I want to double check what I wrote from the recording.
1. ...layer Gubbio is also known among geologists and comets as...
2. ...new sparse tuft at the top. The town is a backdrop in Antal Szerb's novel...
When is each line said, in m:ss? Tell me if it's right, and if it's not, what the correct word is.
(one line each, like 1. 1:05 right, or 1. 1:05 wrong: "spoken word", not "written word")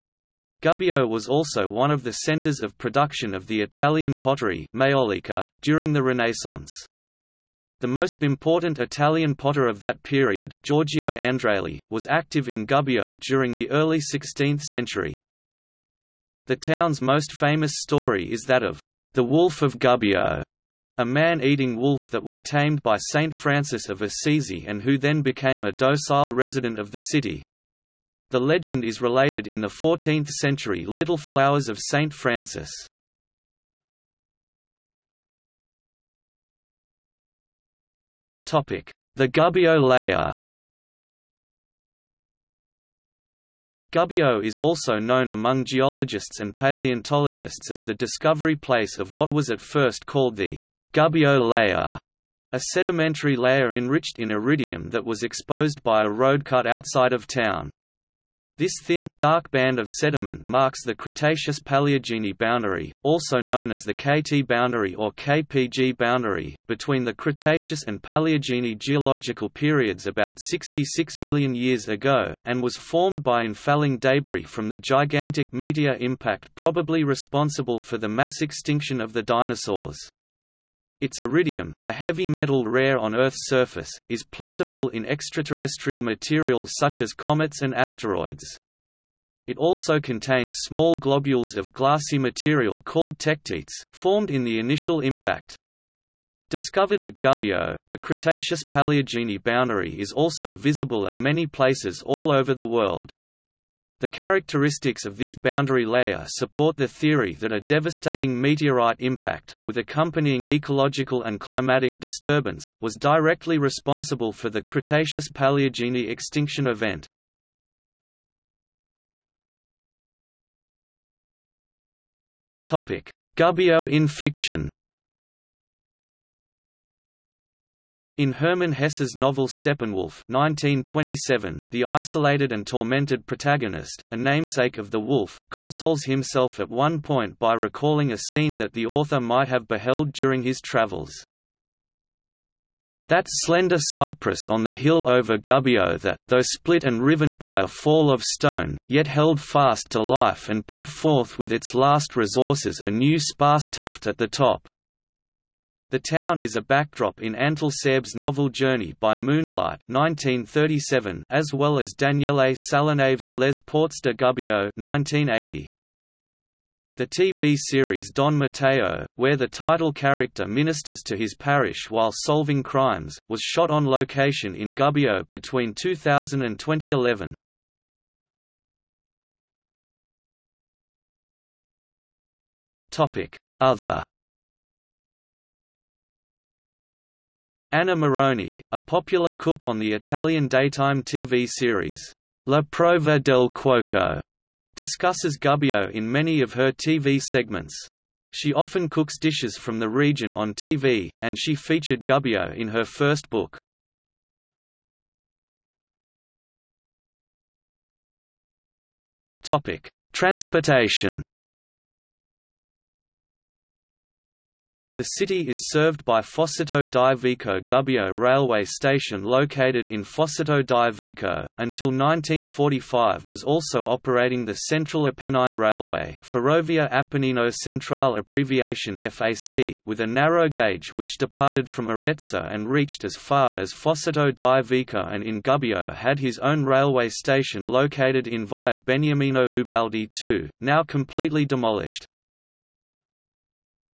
1. 0:39 wrong: "paleontologists", not "comets"
2. 2:32 right.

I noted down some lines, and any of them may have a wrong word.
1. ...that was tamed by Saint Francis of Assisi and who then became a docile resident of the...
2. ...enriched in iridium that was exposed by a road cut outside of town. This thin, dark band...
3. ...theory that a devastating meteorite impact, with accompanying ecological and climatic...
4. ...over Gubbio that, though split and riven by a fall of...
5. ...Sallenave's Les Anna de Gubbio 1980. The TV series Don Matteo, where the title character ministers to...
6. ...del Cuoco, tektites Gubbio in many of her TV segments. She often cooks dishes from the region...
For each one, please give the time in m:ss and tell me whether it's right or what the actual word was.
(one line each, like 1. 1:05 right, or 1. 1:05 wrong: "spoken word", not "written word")
1. 0:22 right
2. 0:53 right
3. 1:46 right
4. 2:25 right
5. 2:42 wrong: "Portes", not "Anna"
6. 3:13 wrong: "discusses", not "tektites".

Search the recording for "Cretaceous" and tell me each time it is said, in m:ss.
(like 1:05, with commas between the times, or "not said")
1:00, 1:07, 1:37, 1:54.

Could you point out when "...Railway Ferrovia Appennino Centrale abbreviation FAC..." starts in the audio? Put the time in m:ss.
3:45.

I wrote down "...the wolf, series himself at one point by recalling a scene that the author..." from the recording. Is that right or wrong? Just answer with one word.
wrong.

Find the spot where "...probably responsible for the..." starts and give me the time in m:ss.
1:16.